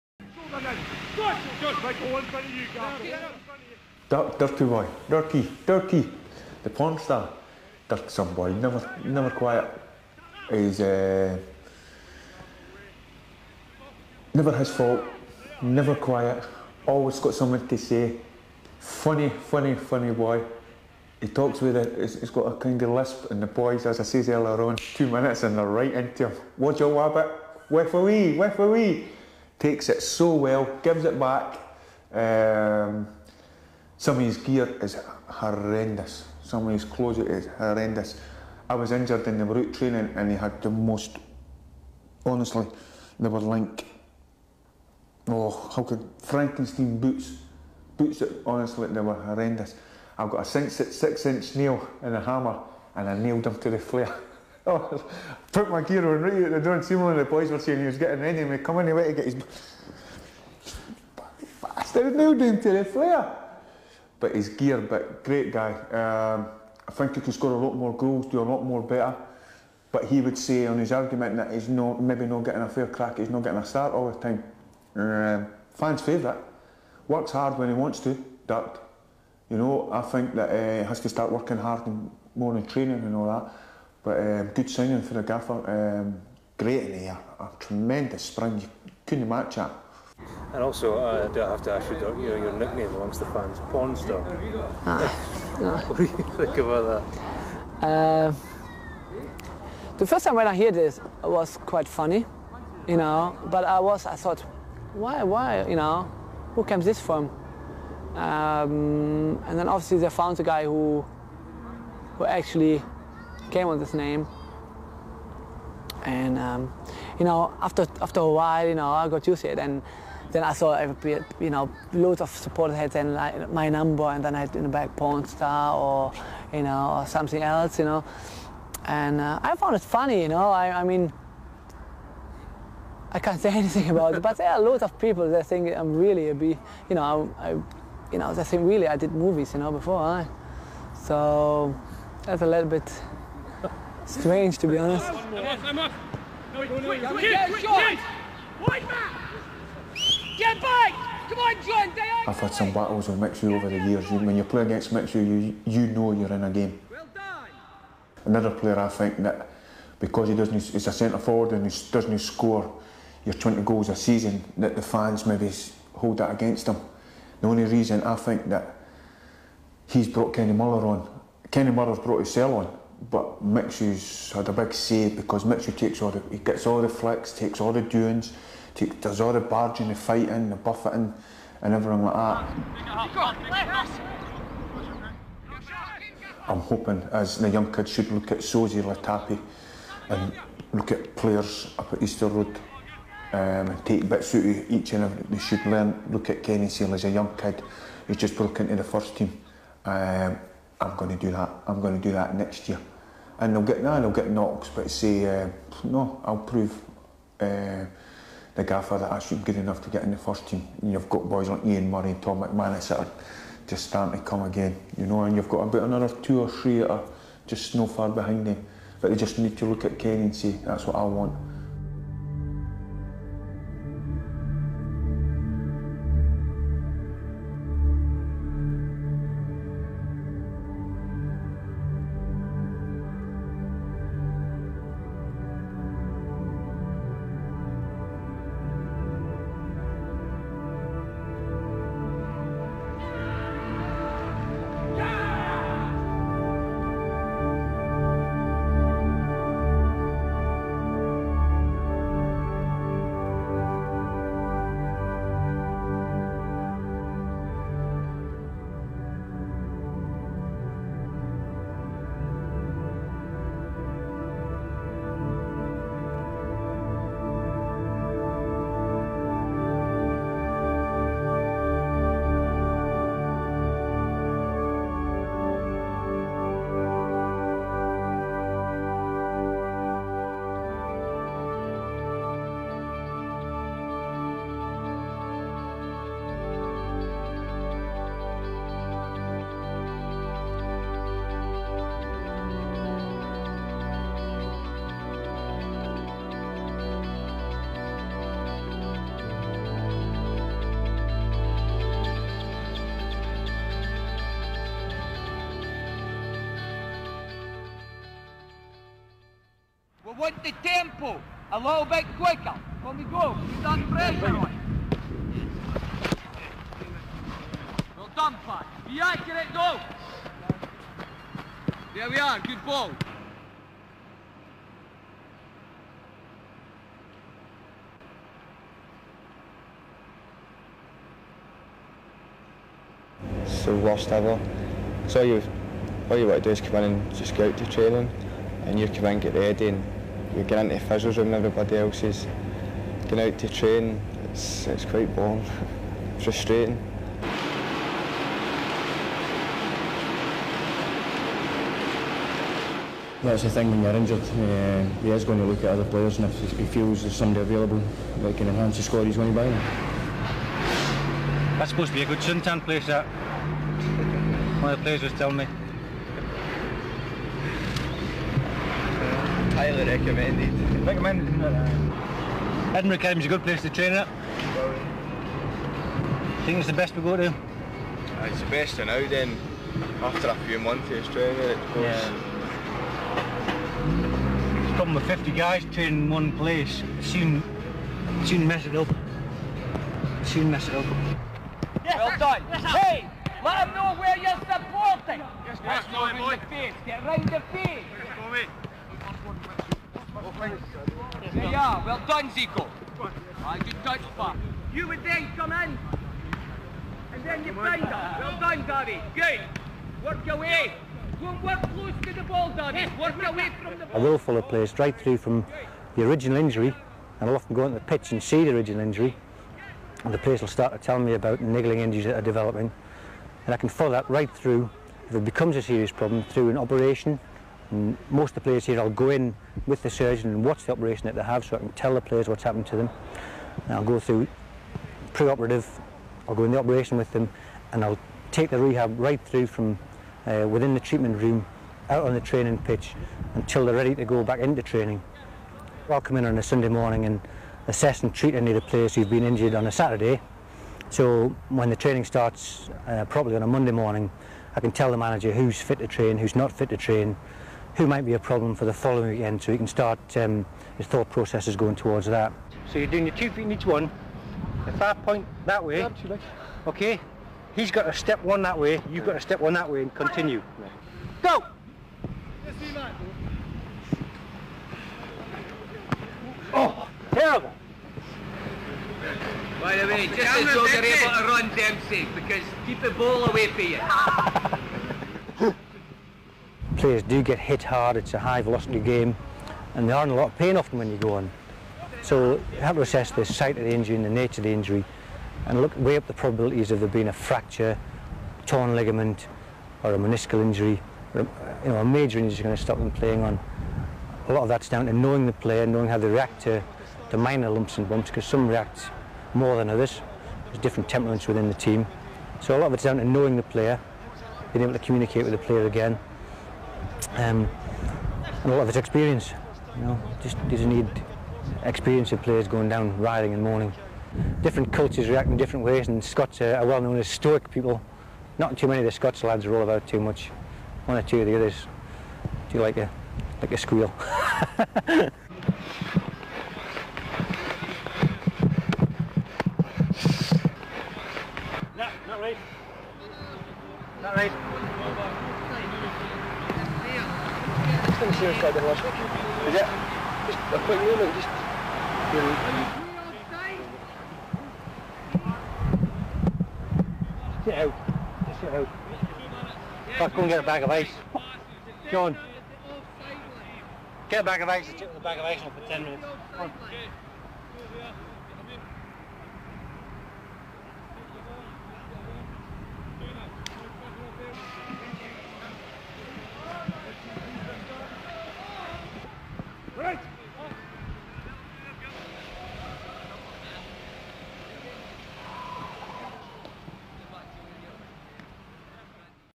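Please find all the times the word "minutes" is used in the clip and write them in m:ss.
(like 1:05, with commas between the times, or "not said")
0:25, 9:25.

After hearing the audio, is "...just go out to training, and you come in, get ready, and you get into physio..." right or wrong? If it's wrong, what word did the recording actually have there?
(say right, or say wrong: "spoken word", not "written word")
right.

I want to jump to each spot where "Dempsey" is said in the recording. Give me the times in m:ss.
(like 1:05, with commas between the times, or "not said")
8:01.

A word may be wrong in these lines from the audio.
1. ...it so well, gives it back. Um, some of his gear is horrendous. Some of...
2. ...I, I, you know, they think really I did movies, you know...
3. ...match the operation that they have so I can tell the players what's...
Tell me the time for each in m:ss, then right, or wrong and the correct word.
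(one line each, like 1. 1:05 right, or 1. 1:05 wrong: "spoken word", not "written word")
1. 0:29 right
2. 2:17 right
3. 7:10 wrong: "watch", not "match".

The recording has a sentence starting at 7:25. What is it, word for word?
I'll come in on a Sunday morning and assess and treat any of the players who've been injured on a Saturday.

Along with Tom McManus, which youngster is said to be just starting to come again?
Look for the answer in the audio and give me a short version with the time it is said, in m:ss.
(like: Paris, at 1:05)
Ian Murray, at 3:31.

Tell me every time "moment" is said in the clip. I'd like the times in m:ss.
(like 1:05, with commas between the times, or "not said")
9:10.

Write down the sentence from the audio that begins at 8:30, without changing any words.
There's different temperaments within the team.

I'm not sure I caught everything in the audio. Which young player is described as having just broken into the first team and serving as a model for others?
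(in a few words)
Kenny Seal.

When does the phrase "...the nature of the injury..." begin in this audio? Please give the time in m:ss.
8:14.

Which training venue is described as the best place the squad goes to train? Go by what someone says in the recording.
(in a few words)
Edinburgh Academy.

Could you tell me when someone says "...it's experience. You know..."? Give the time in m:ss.
8:38.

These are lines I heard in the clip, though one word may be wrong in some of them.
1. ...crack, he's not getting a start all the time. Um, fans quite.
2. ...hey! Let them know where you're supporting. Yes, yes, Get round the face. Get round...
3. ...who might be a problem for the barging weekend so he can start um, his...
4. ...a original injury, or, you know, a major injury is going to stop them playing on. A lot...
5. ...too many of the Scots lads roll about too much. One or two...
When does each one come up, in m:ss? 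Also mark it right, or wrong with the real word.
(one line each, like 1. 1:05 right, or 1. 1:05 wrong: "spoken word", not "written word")
1. 1:12 wrong: "favourite", not "quite"
2. 6:32 right
3. 7:37 wrong: "following", not "barging"
4. 8:19 wrong: "meniscal", not "original"
5. 8:48 right.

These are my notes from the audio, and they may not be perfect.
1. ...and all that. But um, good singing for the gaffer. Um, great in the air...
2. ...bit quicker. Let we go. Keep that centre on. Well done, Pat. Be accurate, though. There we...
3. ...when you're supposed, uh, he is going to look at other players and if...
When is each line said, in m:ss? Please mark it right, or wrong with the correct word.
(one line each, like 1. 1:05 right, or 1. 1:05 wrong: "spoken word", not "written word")
1. 1:22 right
2. 5:11 wrong: "pressure", not "centre"
3. 5:53 wrong: "injured", not "supposed".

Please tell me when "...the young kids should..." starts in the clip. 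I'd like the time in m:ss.
3:07.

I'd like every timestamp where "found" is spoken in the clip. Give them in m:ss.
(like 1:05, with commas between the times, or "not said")
1:50, 2:09.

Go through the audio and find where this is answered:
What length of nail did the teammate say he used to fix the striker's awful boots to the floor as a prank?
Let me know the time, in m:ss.
0:50.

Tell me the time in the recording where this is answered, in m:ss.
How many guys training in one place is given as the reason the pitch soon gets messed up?
6:25.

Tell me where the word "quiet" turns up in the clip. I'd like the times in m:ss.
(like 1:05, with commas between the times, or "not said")
0:09, 0:15.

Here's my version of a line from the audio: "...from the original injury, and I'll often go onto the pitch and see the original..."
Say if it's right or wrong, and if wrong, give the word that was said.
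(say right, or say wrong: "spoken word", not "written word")
right.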